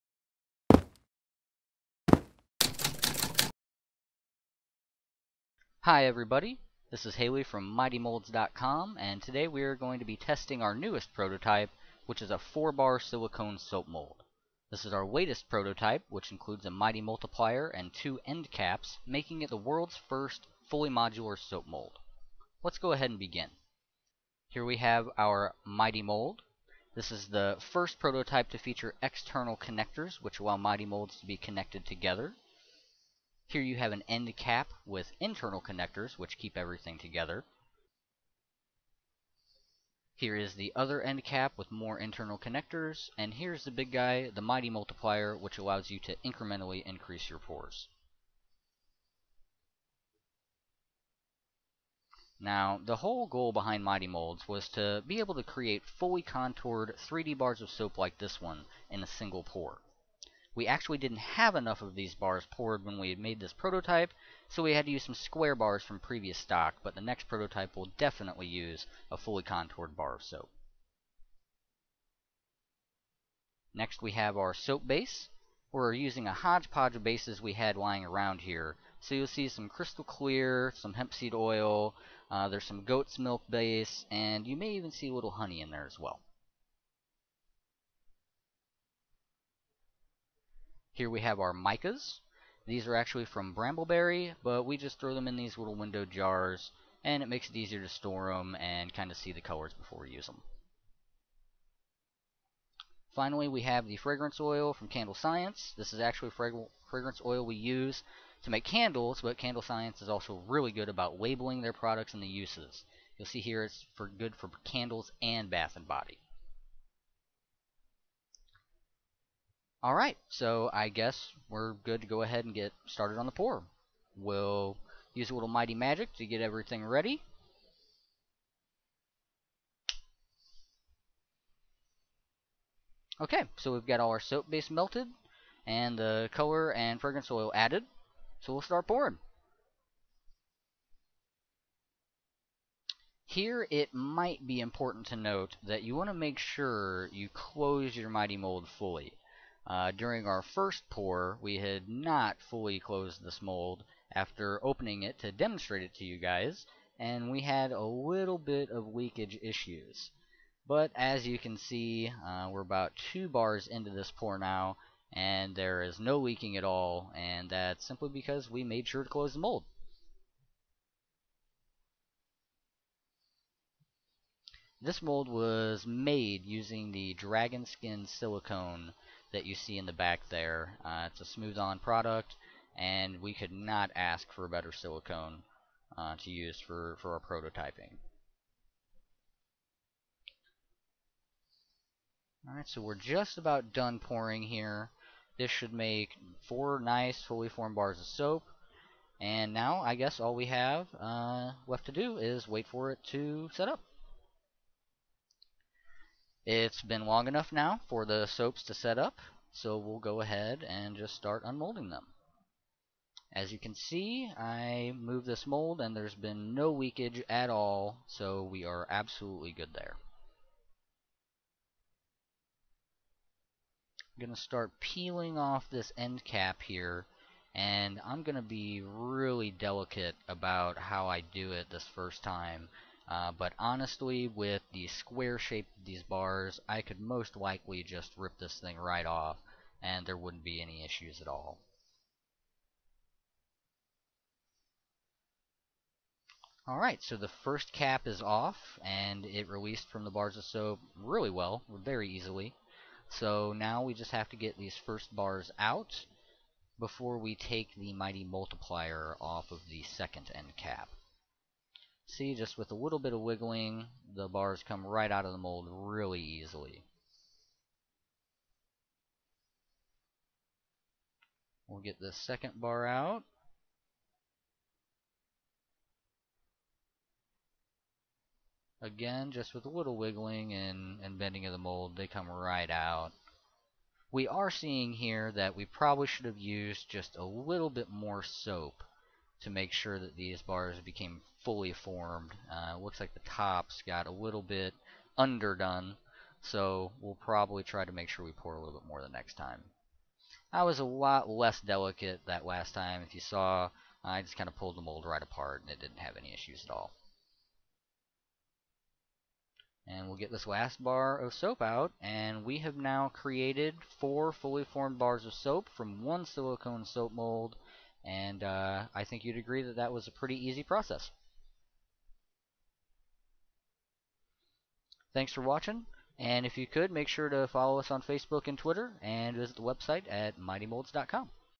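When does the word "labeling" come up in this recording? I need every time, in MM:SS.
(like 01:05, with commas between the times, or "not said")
01:51.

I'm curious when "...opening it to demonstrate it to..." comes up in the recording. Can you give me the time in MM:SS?
02:34.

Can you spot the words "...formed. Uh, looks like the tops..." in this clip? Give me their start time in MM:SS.
04:51.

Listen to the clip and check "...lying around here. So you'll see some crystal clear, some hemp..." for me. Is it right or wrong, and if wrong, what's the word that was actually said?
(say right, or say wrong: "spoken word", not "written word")
right.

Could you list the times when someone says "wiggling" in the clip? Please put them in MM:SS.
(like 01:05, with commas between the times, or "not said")
04:23, 04:39.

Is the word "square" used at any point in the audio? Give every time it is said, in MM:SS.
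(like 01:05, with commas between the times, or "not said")
01:05, 03:54.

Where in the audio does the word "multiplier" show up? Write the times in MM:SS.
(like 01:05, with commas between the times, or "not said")
00:17, 00:44, 04:18.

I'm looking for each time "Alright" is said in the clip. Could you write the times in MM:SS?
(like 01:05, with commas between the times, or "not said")
03:12, 04:06.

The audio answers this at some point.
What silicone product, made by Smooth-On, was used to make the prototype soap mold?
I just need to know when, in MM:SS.
02:57.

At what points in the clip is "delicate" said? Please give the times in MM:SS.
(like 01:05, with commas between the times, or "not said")
03:49, 05:01.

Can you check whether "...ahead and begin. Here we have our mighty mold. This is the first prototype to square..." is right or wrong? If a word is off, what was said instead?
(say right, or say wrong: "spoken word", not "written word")
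wrong: "feature", not "square".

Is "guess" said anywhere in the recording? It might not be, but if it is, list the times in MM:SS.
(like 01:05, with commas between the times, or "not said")
02:00, 03:19.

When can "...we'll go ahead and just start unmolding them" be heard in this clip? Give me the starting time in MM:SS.
03:29.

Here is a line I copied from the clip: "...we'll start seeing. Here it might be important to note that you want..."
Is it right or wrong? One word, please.
wrong.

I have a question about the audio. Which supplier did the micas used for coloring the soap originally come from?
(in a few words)
Brambleberry.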